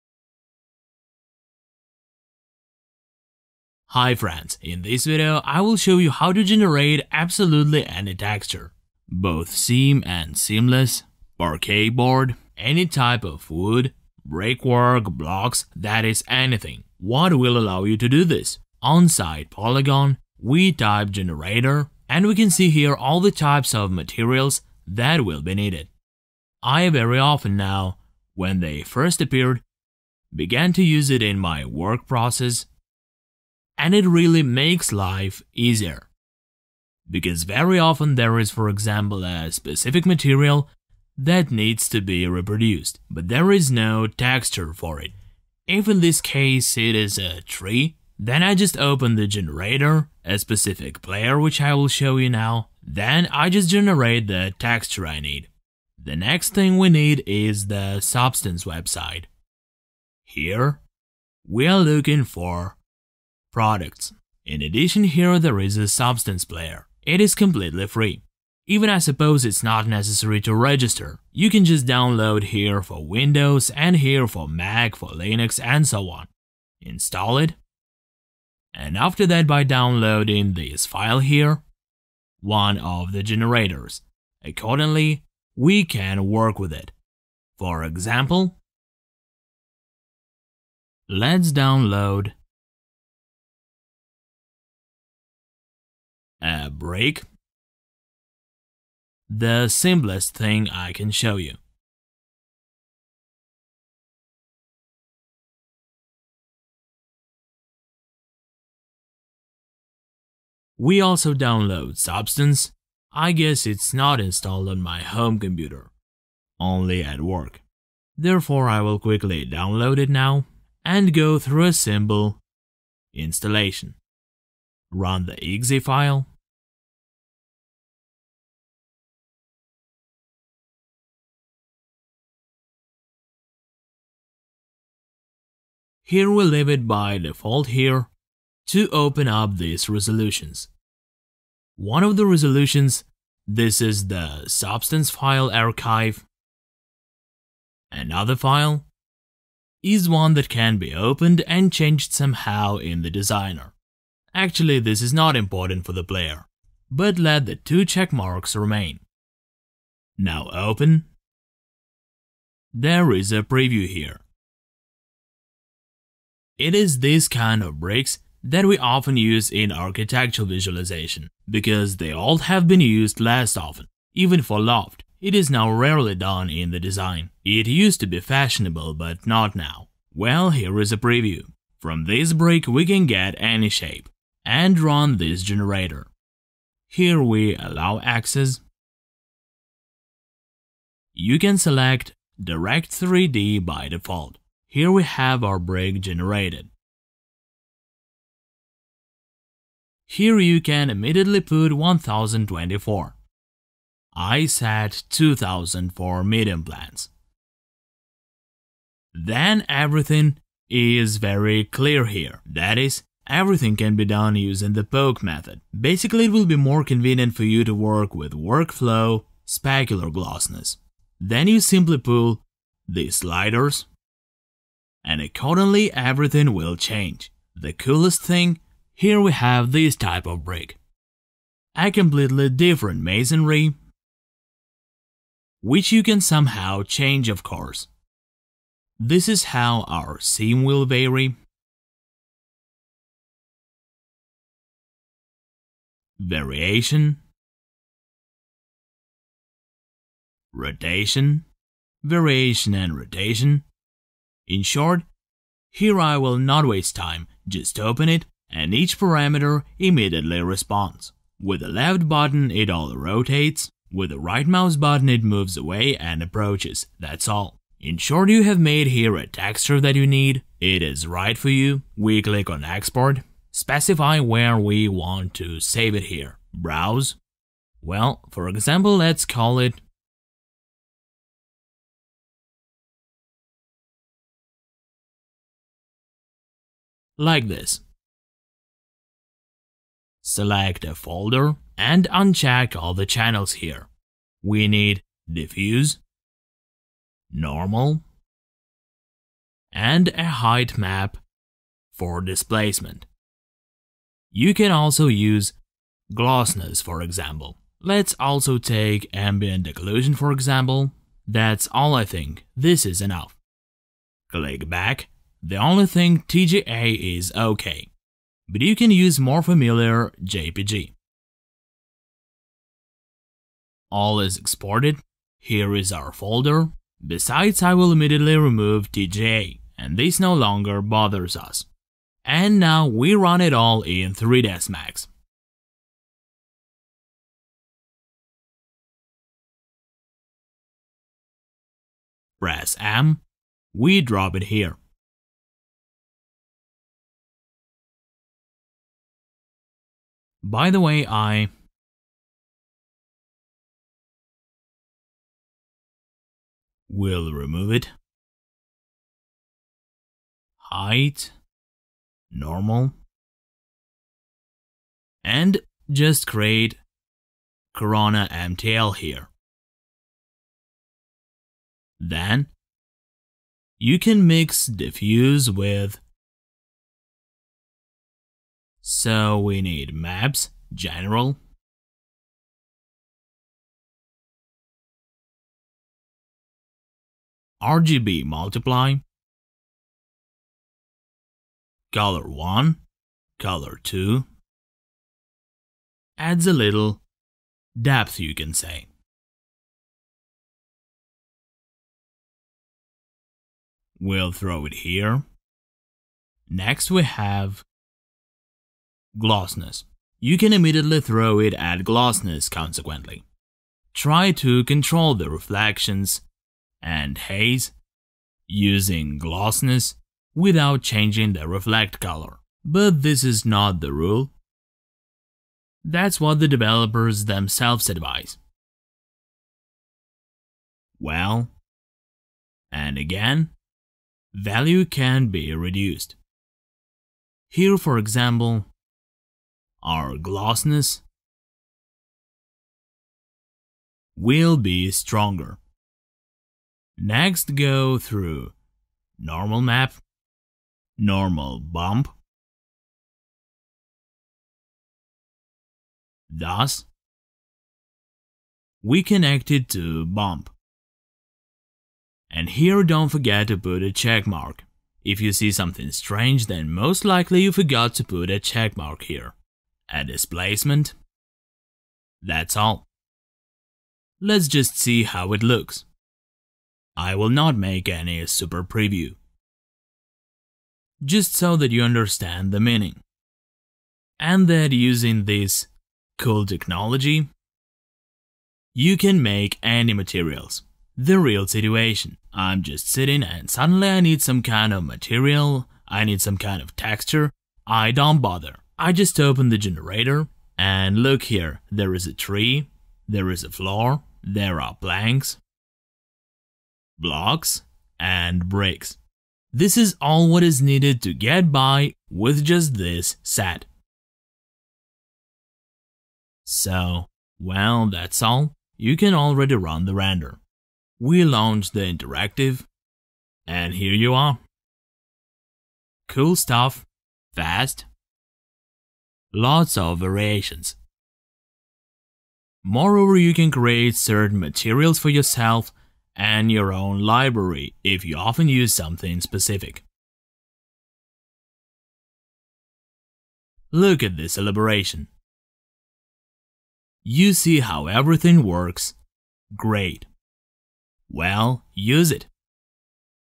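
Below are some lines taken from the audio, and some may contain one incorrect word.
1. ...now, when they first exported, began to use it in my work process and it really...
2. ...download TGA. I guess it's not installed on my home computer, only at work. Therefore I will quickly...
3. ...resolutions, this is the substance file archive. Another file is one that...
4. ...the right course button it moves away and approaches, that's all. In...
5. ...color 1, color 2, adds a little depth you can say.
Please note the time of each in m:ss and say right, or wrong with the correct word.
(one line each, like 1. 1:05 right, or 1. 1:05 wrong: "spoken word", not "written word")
1. 0:27 wrong: "appeared", not "exported"
2. 1:51 wrong: "Substance", not "TGA"
3. 2:22 right
4. 4:24 wrong: "mouse", not "course"
5. 6:31 right.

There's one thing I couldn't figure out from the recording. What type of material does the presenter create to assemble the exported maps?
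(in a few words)
Corona MTL.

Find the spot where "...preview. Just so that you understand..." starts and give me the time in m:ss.
7:58.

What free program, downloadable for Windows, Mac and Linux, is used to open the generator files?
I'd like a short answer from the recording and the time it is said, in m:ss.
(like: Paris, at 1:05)
Substance Player, at 1:05.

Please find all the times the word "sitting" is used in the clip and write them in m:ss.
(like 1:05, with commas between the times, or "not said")
8:12.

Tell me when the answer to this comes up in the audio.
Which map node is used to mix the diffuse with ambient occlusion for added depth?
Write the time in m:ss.
6:27.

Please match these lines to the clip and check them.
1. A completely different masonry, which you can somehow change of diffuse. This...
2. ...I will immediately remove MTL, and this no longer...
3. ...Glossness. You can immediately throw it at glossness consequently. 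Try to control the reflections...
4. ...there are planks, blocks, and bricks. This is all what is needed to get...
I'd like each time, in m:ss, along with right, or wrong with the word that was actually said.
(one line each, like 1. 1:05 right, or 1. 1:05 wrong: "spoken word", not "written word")
1. 3:51 wrong: "course", not "diffuse"
2. 5:27 wrong: "TGA", not "MTL"
3. 6:49 right
4. 8:24 right.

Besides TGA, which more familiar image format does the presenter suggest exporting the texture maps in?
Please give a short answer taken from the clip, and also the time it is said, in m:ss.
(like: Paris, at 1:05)
JPG, at 5:20.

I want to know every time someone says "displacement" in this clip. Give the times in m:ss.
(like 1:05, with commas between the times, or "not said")
5:02, 7:50.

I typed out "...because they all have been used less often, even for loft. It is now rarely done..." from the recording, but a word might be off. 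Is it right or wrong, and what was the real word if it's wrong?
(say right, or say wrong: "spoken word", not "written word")
right.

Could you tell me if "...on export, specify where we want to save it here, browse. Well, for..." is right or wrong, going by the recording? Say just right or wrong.
right.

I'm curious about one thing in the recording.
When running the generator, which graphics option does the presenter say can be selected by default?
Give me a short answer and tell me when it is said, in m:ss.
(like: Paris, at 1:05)
Direct 3D, at 3:12.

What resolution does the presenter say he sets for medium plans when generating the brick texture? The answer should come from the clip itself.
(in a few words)
2000.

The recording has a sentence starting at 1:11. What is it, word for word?
You can just download here for Windows and here for Mac, for Linux and so on.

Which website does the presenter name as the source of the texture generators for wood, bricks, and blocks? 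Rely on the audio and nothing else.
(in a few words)
Poliigon.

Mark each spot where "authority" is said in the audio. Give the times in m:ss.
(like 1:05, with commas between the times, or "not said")
not said.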